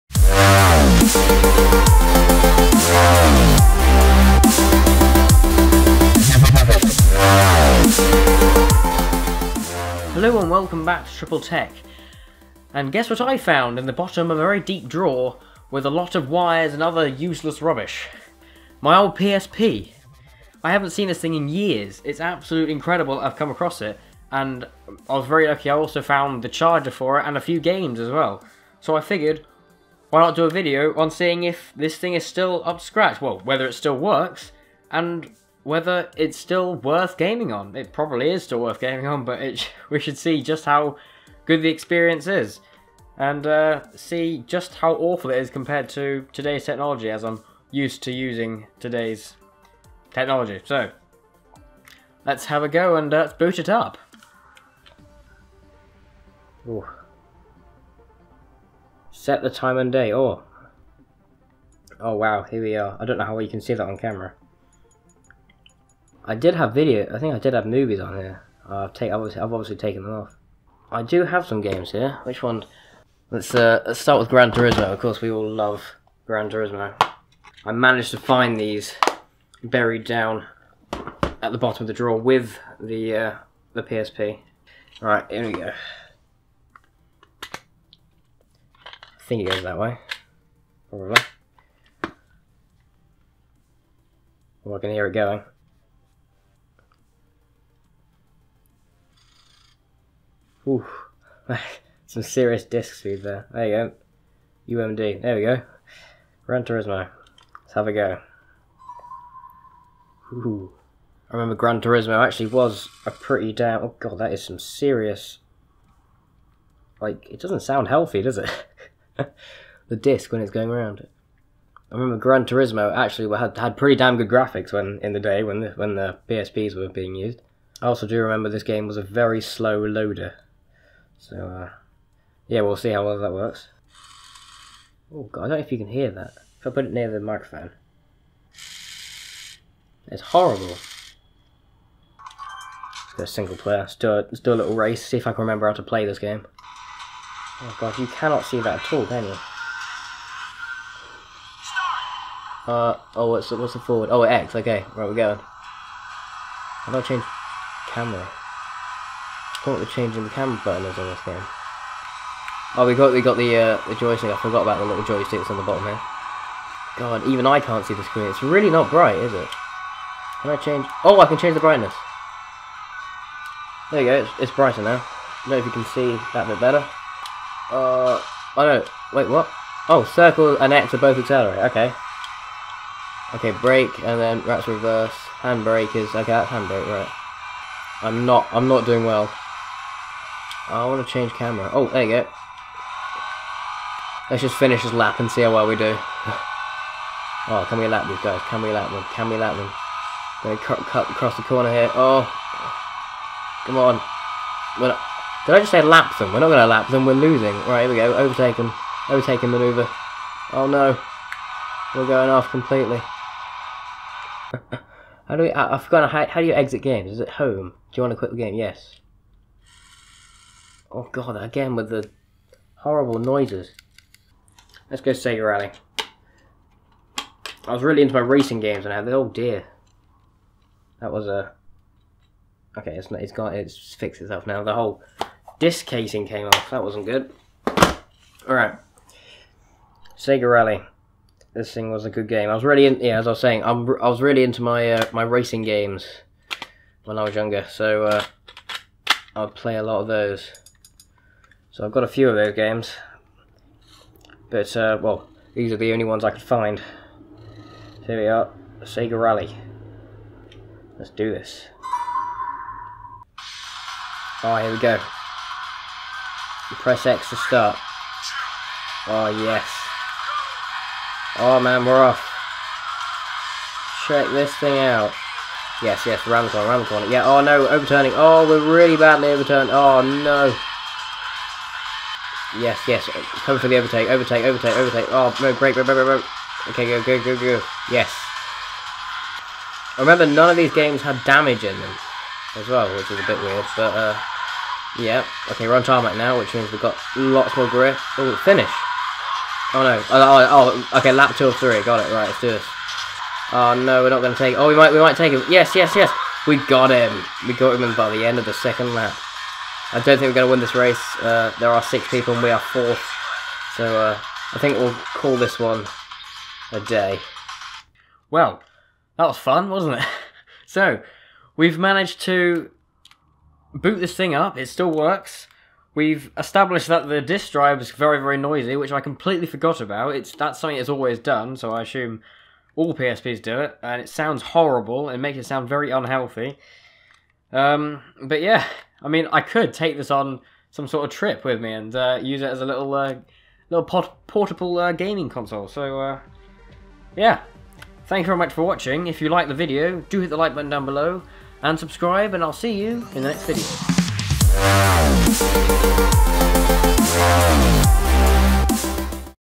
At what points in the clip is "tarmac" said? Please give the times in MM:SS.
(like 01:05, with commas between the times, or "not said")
04:55.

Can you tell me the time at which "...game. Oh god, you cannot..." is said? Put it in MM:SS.
02:26.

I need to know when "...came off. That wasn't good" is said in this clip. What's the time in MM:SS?
03:56.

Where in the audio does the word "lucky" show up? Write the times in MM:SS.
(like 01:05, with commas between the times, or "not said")
00:25.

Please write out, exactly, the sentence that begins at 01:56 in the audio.
Like, it doesn't sound healthy, does it?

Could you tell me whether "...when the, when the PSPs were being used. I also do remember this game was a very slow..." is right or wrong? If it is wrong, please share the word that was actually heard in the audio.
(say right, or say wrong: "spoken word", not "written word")
right.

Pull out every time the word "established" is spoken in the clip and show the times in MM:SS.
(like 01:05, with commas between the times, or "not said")
05:26.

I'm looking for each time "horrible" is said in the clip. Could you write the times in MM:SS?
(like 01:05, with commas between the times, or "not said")
02:20, 03:42, 05:34.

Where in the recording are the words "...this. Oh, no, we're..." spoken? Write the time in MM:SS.
05:02.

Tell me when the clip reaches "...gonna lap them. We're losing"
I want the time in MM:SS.
03:26.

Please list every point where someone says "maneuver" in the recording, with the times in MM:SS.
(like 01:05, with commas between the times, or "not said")
03:29.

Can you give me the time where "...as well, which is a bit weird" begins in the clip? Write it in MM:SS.
04:52.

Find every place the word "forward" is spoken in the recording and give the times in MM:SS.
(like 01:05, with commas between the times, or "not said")
02:33.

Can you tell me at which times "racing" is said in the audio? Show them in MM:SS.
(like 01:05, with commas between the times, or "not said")
03:48, 04:05.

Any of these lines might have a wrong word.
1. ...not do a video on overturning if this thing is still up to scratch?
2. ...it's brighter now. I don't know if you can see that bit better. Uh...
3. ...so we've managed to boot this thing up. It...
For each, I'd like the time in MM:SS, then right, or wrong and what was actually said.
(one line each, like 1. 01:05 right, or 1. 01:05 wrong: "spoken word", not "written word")
1. 00:30 wrong: "seeing", not "overturning"
2. 02:54 right
3. 05:20 right.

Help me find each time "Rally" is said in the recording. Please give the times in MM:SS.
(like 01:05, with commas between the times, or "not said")
03:45, 04:00, 04:19.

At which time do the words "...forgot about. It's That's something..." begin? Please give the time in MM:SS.
05:29.